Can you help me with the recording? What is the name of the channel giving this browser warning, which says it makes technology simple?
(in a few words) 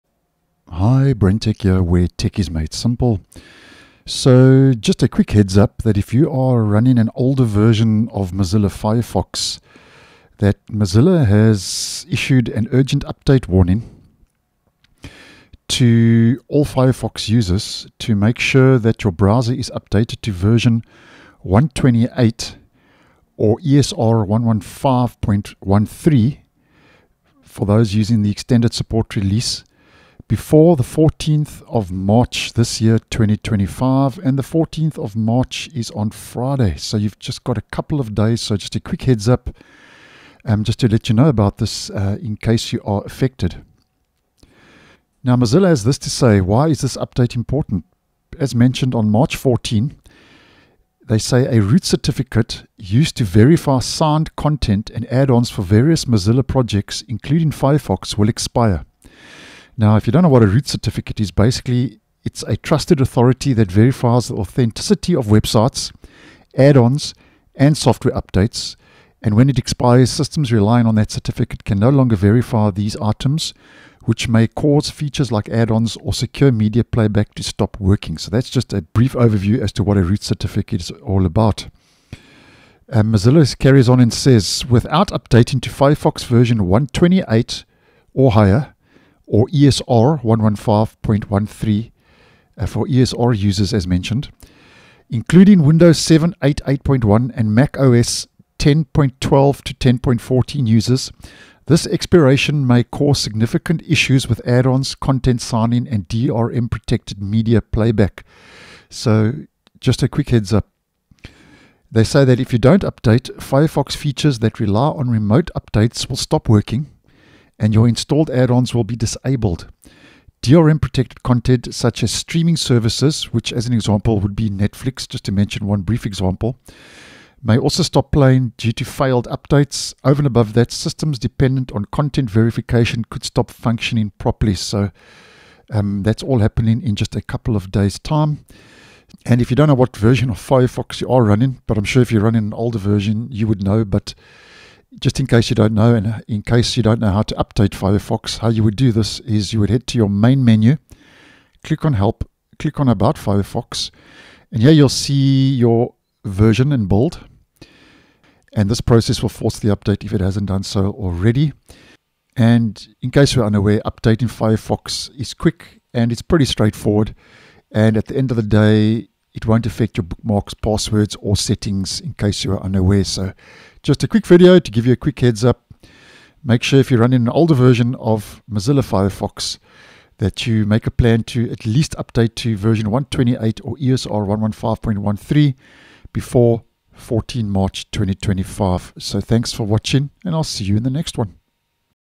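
BrenTech.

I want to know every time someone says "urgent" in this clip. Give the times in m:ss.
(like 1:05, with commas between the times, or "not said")
0:12.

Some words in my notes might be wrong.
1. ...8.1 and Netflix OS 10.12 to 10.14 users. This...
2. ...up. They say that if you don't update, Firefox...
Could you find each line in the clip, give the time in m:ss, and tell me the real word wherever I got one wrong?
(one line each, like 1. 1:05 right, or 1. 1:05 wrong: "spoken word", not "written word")
1. 1:36 wrong: "Mac", not "Netflix"
2. 1:50 right.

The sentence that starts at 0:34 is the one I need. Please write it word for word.
And the 14th of March is on Friday.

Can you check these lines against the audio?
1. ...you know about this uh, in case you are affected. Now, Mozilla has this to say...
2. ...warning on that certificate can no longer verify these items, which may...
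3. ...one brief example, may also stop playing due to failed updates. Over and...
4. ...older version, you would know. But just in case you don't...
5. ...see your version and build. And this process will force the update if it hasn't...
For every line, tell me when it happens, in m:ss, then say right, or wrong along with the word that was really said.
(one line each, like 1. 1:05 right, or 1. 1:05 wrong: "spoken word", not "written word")
1. 0:41 right
2. 1:10 wrong: "relying", not "warning"
3. 2:05 right
4. 2:22 right
5. 2:34 right.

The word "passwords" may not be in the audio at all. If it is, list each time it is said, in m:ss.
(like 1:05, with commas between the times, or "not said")
2:50.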